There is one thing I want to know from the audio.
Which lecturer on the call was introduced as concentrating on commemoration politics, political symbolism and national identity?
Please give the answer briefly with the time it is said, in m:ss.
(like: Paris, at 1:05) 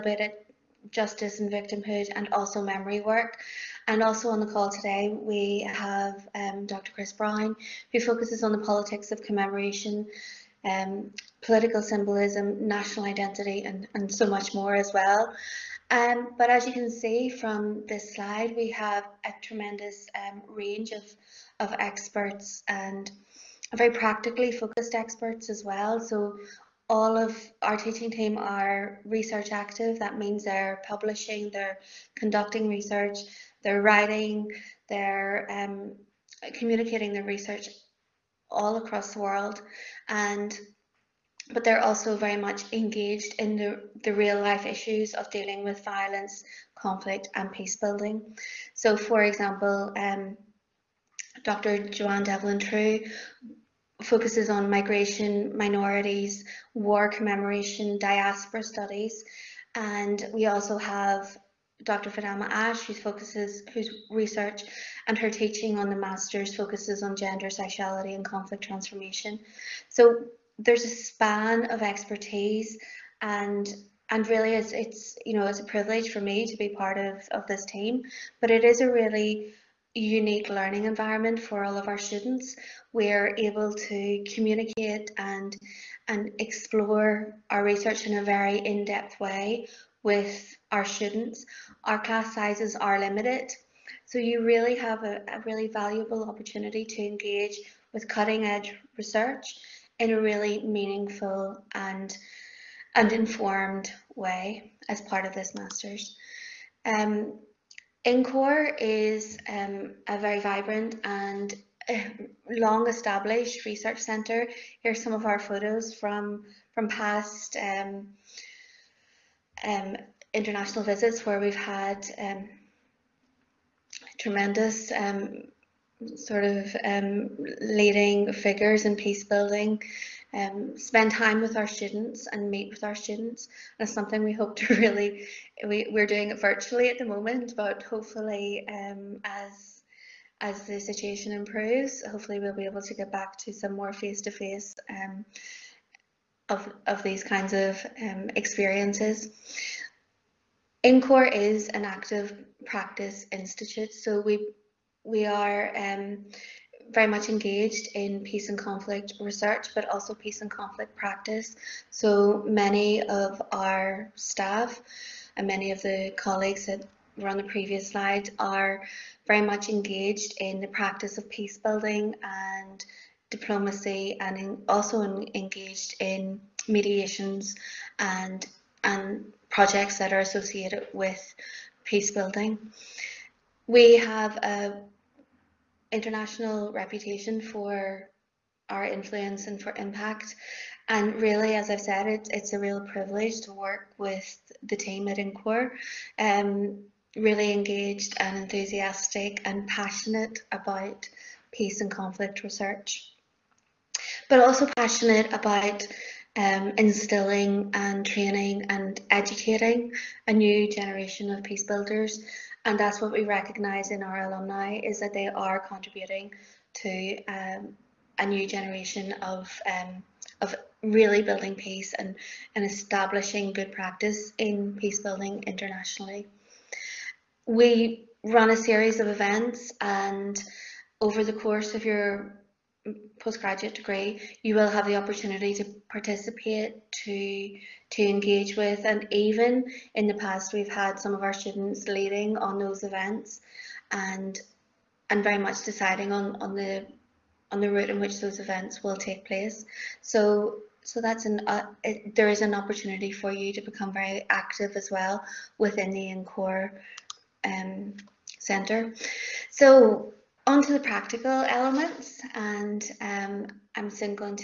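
Dr. Chris Brown, at 0:06.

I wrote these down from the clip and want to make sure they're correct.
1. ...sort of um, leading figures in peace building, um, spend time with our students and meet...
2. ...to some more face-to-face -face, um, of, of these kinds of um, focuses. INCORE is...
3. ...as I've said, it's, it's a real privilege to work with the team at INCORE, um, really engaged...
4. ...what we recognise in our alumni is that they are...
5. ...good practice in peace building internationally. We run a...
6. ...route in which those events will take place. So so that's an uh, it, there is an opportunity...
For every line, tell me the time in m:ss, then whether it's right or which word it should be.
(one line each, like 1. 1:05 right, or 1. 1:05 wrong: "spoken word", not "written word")
1. 2:06 right
2. 2:23 wrong: "experiences", not "focuses"
3. 3:11 right
4. 3:33 right
5. 3:43 right
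6. 4:07 right.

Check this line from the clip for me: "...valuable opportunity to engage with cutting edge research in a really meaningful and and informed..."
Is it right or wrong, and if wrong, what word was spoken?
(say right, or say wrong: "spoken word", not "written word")
right.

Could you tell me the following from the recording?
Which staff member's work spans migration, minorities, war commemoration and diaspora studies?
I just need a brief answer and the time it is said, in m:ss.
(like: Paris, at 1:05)
Dr. Johanne Devlin Trew, at 0:51.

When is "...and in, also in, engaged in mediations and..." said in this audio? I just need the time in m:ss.
2:54.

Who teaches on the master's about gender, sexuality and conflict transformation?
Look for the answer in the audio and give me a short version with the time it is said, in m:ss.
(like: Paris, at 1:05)
Dr. Fidelma Ashe, at 1:01.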